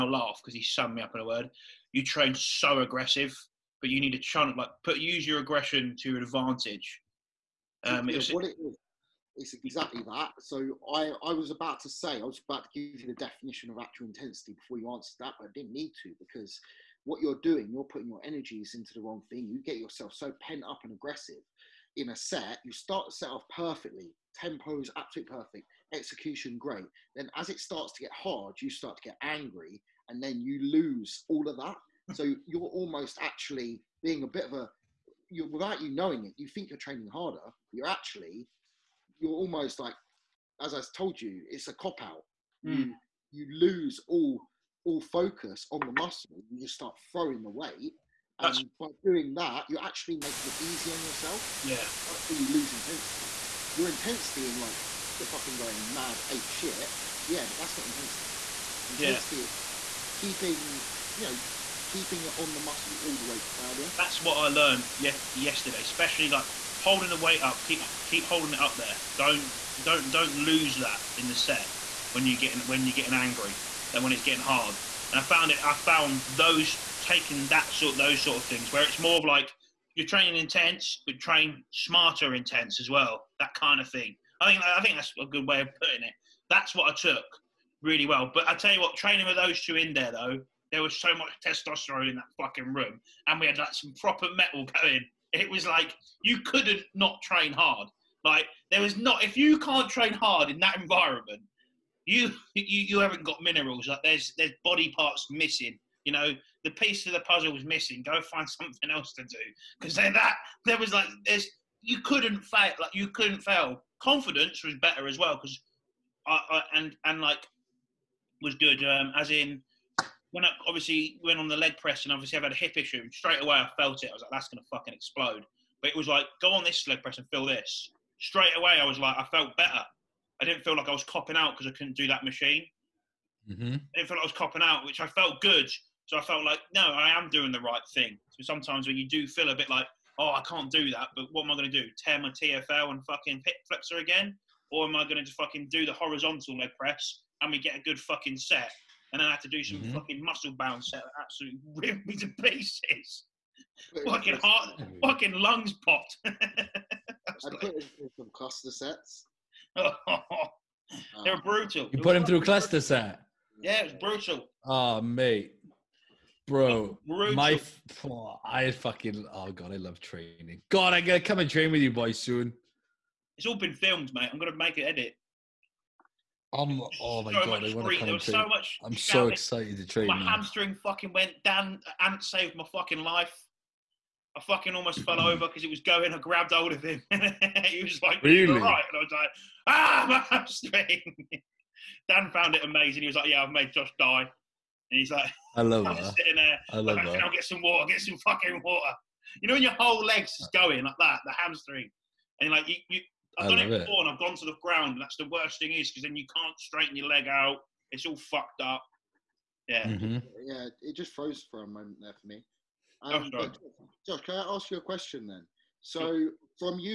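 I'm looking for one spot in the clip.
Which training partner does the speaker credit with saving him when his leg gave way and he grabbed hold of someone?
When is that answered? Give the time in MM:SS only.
03:02.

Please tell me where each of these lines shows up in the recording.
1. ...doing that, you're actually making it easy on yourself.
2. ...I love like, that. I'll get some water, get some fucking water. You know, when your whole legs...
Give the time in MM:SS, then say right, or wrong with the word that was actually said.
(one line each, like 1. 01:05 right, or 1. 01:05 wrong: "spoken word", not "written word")
1. 00:49 right
2. 03:16 right.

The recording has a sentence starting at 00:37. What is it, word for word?
You're actually, you're almost like, as I told you, it's a cop out.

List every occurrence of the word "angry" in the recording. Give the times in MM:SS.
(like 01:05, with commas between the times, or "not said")
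00:29, 01:13.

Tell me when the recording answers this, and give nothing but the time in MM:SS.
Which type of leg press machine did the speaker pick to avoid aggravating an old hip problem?
02:25.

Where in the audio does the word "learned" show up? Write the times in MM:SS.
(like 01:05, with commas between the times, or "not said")
01:04.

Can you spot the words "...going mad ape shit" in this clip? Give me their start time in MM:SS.
00:55.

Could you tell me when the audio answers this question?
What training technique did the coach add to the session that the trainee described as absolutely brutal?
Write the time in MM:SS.
02:38.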